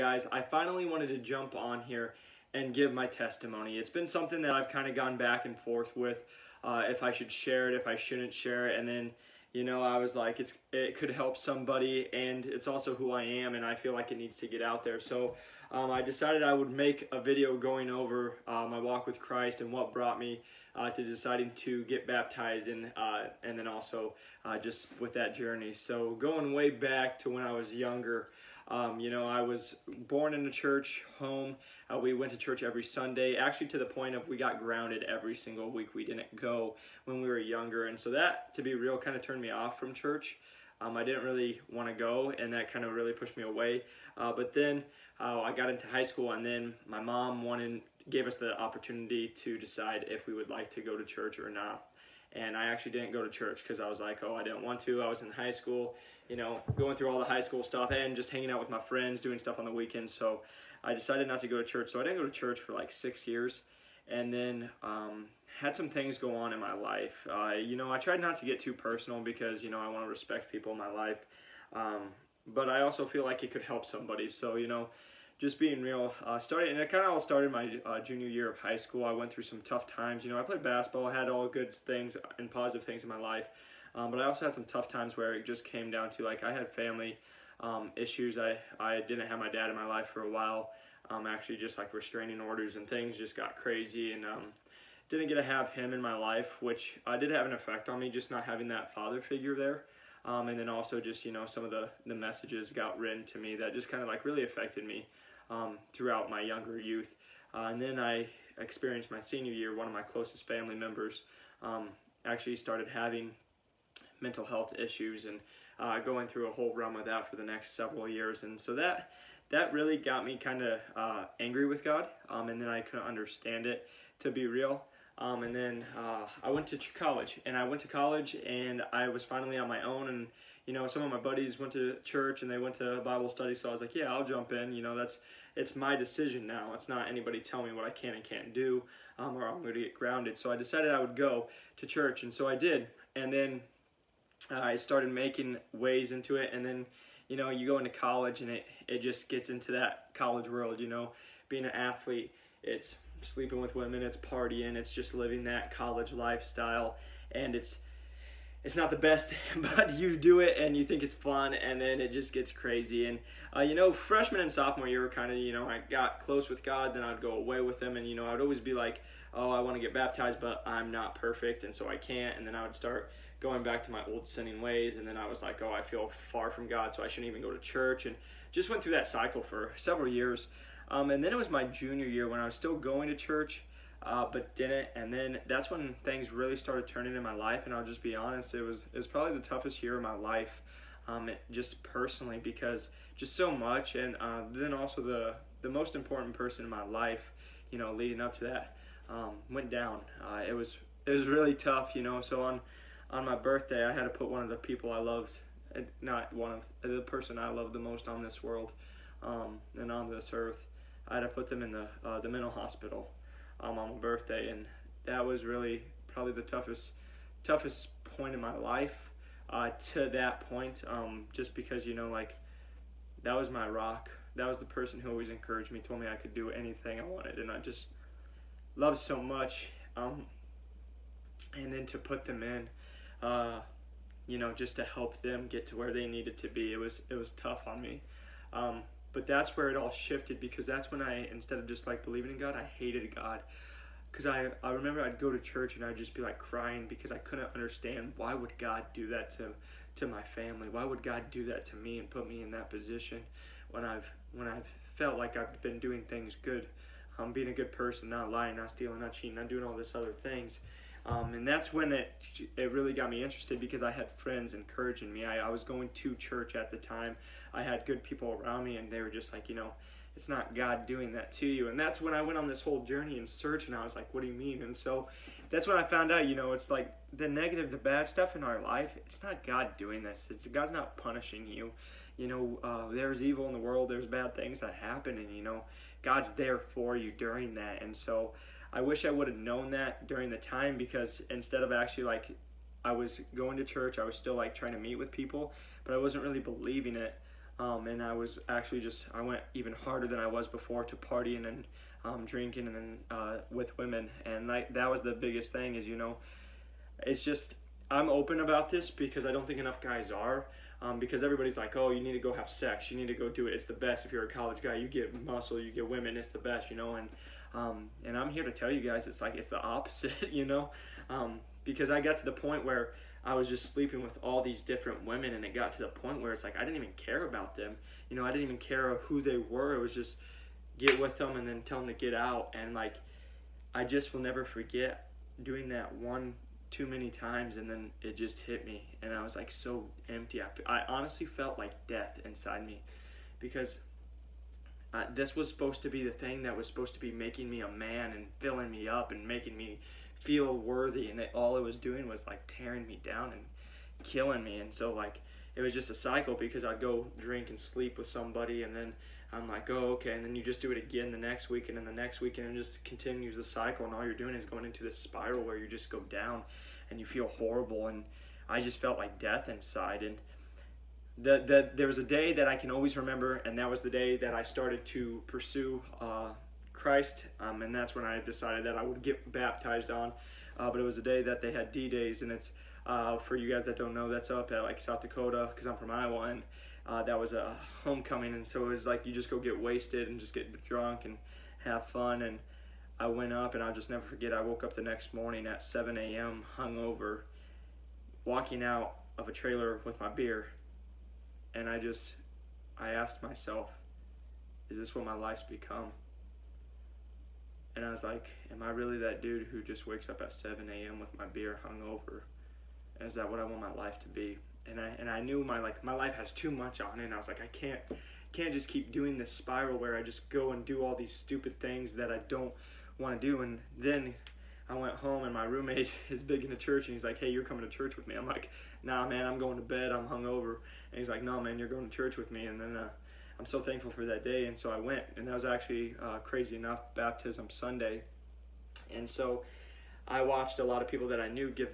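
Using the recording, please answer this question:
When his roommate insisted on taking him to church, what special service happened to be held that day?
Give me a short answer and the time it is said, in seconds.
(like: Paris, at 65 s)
Baptism Sunday, at 436 s.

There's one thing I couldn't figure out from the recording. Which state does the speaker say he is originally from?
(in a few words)
Iowa.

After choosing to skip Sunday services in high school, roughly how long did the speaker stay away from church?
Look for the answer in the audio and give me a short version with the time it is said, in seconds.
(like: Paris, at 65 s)
6 years, at 62 s.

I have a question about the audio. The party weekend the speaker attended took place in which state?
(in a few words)
South Dakota.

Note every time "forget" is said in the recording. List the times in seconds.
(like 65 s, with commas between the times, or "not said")
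334 s, 394 s.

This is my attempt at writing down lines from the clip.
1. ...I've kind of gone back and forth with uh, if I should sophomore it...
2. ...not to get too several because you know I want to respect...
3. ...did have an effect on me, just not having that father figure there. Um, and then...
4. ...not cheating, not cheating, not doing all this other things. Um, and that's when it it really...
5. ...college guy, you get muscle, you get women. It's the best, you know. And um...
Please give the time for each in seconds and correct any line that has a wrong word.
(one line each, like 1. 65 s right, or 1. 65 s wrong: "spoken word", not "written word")
1. 4 s wrong: "share", not "sophomore"
2. 68 s wrong: "personal", not "several"
3. 97 s right
4. 258 s wrong: "stealing", not "cheating"
5. 314 s right.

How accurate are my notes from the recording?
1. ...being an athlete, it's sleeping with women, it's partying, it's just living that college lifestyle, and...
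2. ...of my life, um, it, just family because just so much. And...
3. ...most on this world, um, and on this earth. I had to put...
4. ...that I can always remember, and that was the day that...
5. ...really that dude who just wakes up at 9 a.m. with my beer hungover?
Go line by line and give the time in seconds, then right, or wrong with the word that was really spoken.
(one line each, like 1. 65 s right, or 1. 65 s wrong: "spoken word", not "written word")
1. 151 s right
2. 189 s wrong: "personally", not "family"
3. 207 s right
4. 372 s right
5. 408 s wrong: "7", not "9".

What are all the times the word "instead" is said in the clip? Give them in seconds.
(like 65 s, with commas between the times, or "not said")
241 s, 291 s.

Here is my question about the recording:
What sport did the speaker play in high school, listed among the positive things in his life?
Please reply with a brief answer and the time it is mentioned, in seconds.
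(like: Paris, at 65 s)
Basketball, at 80 s.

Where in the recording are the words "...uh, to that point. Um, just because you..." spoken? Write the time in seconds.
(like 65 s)
219 s.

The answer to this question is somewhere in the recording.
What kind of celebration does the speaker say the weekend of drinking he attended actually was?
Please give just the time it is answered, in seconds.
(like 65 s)
387 s.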